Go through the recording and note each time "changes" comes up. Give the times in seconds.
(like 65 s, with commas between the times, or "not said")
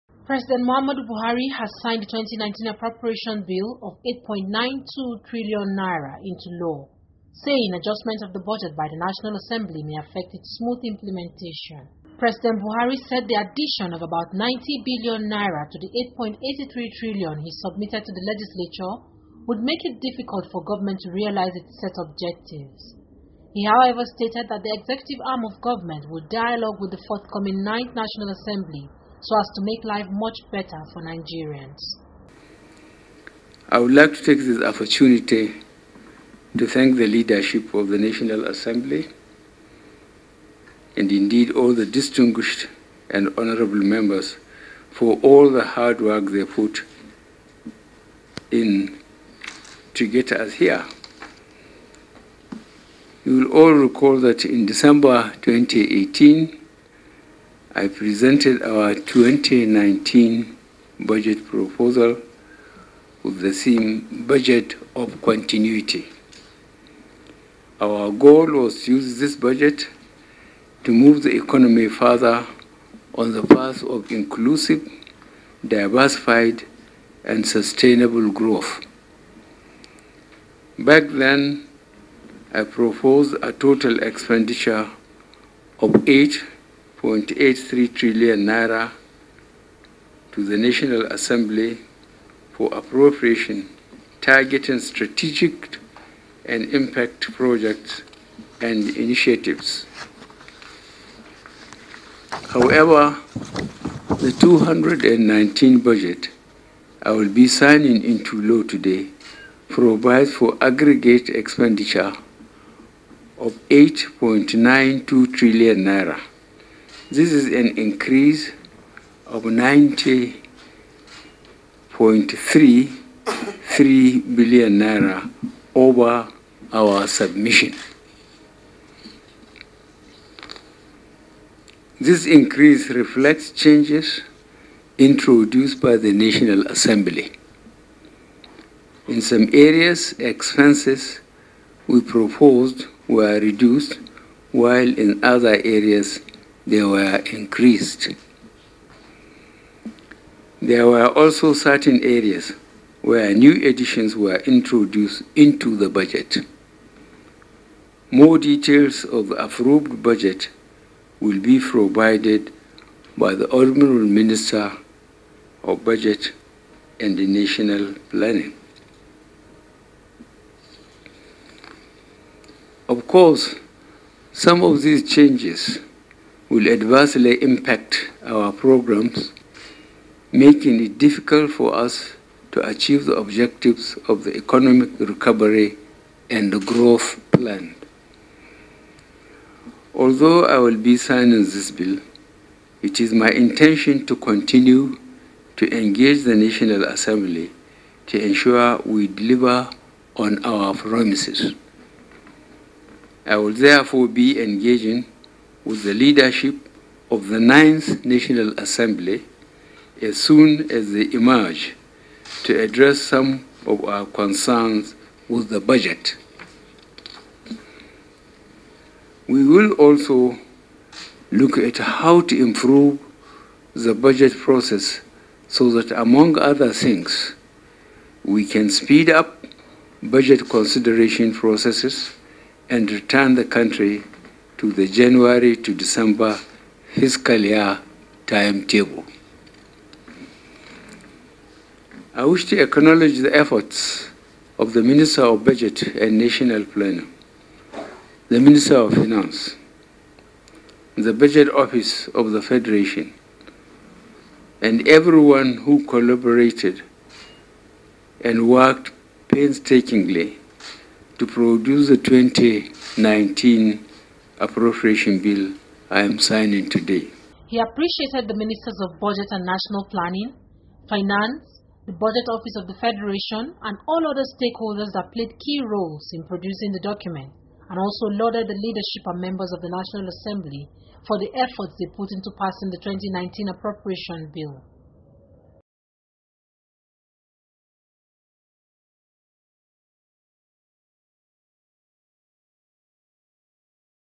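133 s, 175 s.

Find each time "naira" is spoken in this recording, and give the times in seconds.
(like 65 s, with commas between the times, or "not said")
5 s, 15 s, 88 s, 115 s, 124 s.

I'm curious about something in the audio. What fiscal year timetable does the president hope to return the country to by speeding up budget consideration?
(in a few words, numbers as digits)
January to December.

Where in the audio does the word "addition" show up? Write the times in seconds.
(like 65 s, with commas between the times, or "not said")
13 s, 153 s.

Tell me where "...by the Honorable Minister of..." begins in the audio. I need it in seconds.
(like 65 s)
163 s.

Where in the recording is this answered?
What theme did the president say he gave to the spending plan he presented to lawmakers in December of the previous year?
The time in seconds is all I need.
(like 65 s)
64 s.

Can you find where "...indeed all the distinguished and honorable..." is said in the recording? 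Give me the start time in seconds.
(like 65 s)
41 s.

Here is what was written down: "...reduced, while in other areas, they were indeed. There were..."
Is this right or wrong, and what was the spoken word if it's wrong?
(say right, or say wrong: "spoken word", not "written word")
wrong: "increased", not "indeed".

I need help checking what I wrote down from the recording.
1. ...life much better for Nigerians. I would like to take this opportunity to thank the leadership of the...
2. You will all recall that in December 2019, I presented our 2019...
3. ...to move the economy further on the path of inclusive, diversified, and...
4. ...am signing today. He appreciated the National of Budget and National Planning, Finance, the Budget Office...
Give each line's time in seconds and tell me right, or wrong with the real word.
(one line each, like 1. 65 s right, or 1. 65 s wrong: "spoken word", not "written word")
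1. 29 s right
2. 53 s wrong: "2018", not "2019"
3. 70 s right
4. 266 s wrong: "Ministers", not "National".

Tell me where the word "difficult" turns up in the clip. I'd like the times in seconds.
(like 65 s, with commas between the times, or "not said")
19 s, 180 s.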